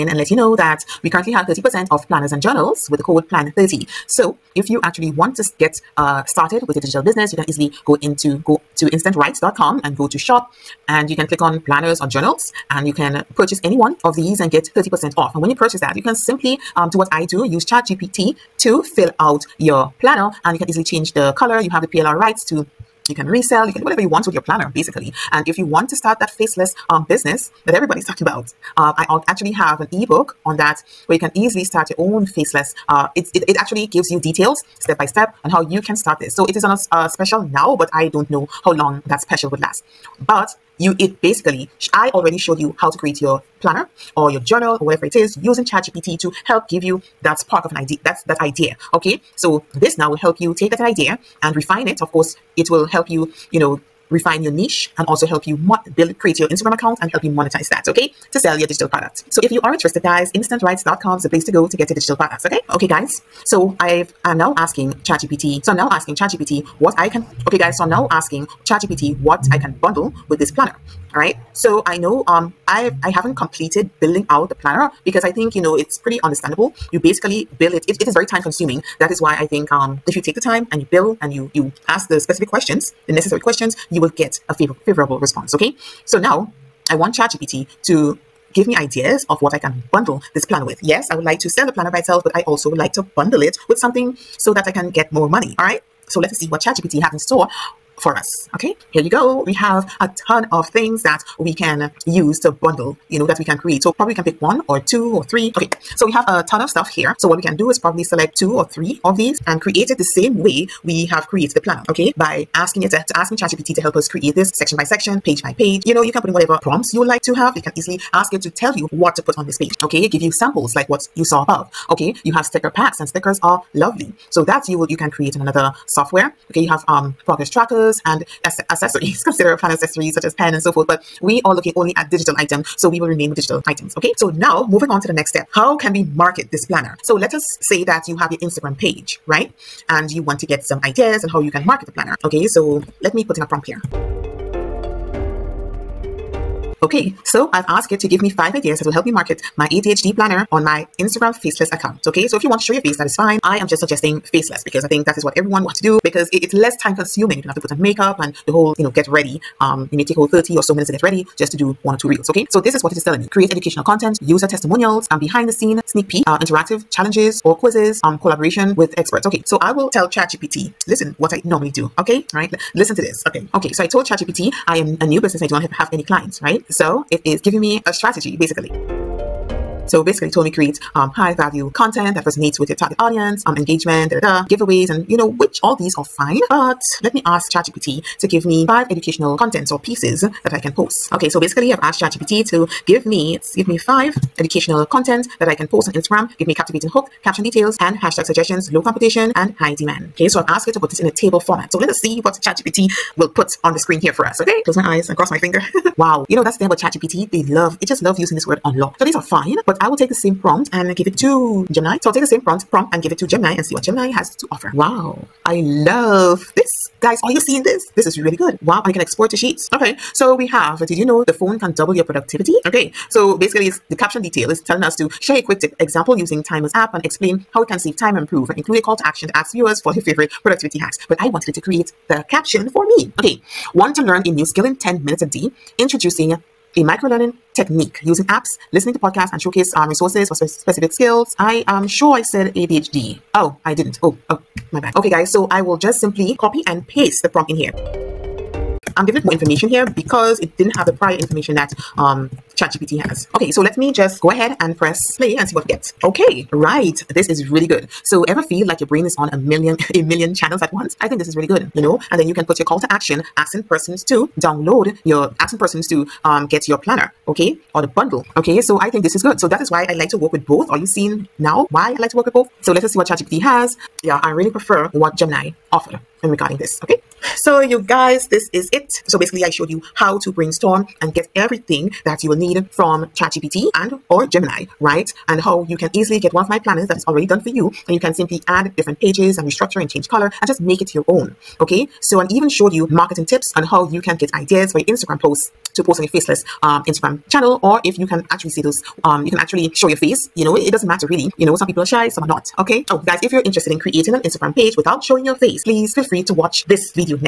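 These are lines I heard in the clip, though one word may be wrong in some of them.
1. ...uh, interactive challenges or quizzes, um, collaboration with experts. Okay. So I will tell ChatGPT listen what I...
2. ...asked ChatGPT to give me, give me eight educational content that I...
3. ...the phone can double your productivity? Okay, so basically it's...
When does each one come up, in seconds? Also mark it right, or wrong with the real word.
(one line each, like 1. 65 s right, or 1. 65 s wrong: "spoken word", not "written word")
1. 166 s right
2. 191 s wrong: "five", not "eight"
3. 221 s right.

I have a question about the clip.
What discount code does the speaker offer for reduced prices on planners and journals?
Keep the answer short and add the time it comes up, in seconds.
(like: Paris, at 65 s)
PLAN30, at 3 s.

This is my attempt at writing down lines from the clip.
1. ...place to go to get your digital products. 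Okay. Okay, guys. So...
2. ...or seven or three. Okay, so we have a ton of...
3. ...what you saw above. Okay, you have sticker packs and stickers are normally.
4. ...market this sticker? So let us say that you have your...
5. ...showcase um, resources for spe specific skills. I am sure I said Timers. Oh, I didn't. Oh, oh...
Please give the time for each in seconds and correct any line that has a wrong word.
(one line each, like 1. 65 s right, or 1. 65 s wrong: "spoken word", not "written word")
1. 61 s right
2. 104 s wrong: "two", not "seven"
3. 120 s wrong: "lovely", not "normally"
4. 136 s wrong: "planner", not "sticker"
5. 239 s wrong: "ADHD", not "Timers".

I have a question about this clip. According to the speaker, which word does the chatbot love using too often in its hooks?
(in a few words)
unlock.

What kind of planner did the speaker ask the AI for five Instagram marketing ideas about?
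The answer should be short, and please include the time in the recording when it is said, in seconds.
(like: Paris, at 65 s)
ADHD planner, at 149 s.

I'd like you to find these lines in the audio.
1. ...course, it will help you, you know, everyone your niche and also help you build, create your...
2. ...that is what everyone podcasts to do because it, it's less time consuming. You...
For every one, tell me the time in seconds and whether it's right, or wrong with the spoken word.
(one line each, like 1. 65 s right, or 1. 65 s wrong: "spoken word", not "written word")
1. 52 s wrong: "refine", not "everyone"
2. 155 s wrong: "wants", not "podcasts".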